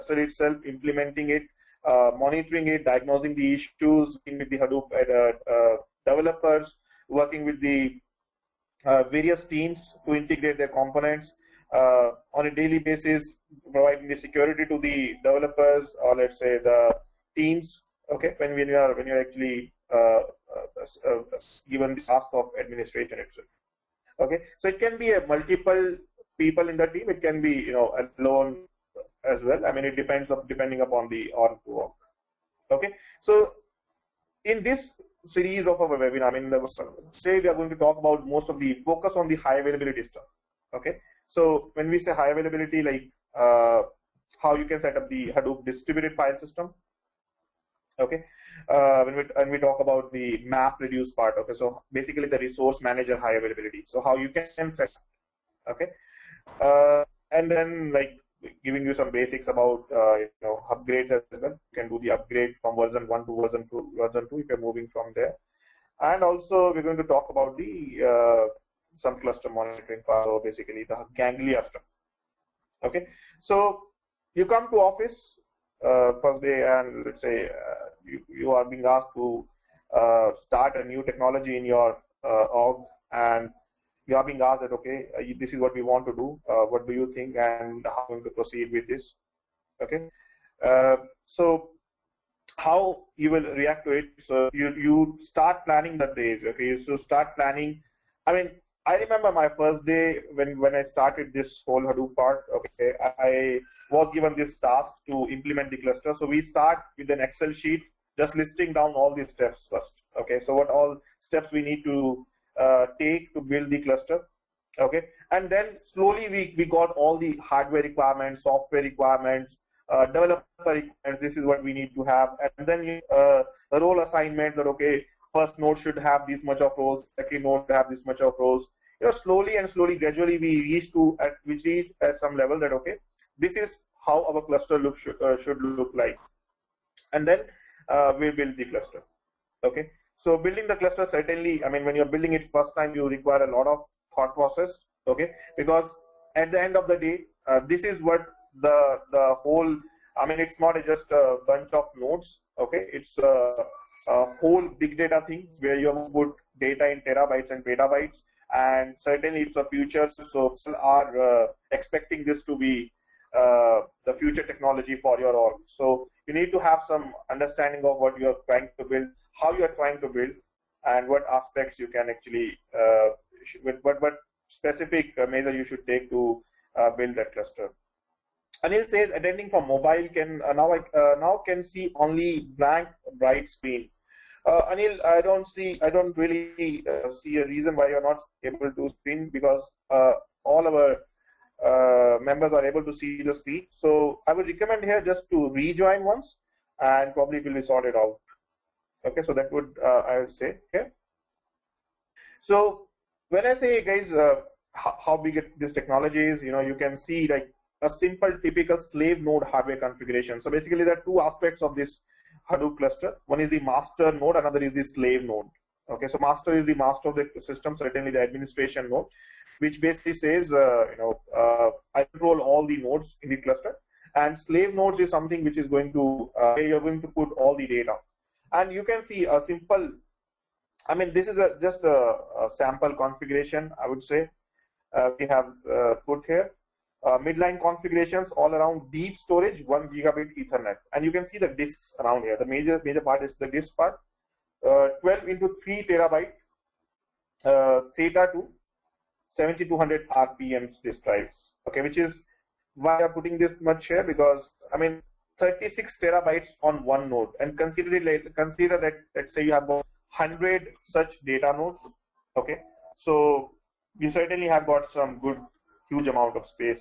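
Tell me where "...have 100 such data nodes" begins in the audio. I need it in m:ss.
4:19.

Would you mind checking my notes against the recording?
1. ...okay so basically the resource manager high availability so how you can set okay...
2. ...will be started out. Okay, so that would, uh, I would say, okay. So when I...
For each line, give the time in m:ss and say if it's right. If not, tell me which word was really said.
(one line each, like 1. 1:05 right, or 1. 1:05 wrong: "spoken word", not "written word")
1. 0:51 right
2. 3:17 wrong: "sorted", not "started".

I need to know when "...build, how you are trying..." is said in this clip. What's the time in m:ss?
2:48.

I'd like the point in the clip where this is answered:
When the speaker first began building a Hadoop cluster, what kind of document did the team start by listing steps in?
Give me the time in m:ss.
1:47.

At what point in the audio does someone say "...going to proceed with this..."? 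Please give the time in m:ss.
1:28.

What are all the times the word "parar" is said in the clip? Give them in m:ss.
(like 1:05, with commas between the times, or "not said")
not said.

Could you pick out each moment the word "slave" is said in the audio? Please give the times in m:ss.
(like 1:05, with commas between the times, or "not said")
3:28, 3:34, 3:44.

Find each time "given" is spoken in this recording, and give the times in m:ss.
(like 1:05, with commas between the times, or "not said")
0:21, 1:44.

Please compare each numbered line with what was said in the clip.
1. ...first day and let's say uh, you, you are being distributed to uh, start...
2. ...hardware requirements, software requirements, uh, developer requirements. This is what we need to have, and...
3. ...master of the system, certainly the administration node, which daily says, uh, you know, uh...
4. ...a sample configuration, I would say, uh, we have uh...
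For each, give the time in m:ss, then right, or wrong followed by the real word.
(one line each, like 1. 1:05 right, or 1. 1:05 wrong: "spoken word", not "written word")
1. 1:16 wrong: "asked", not "distributed"
2. 1:57 right
3. 3:36 wrong: "basically", not "daily"
4. 3:52 right.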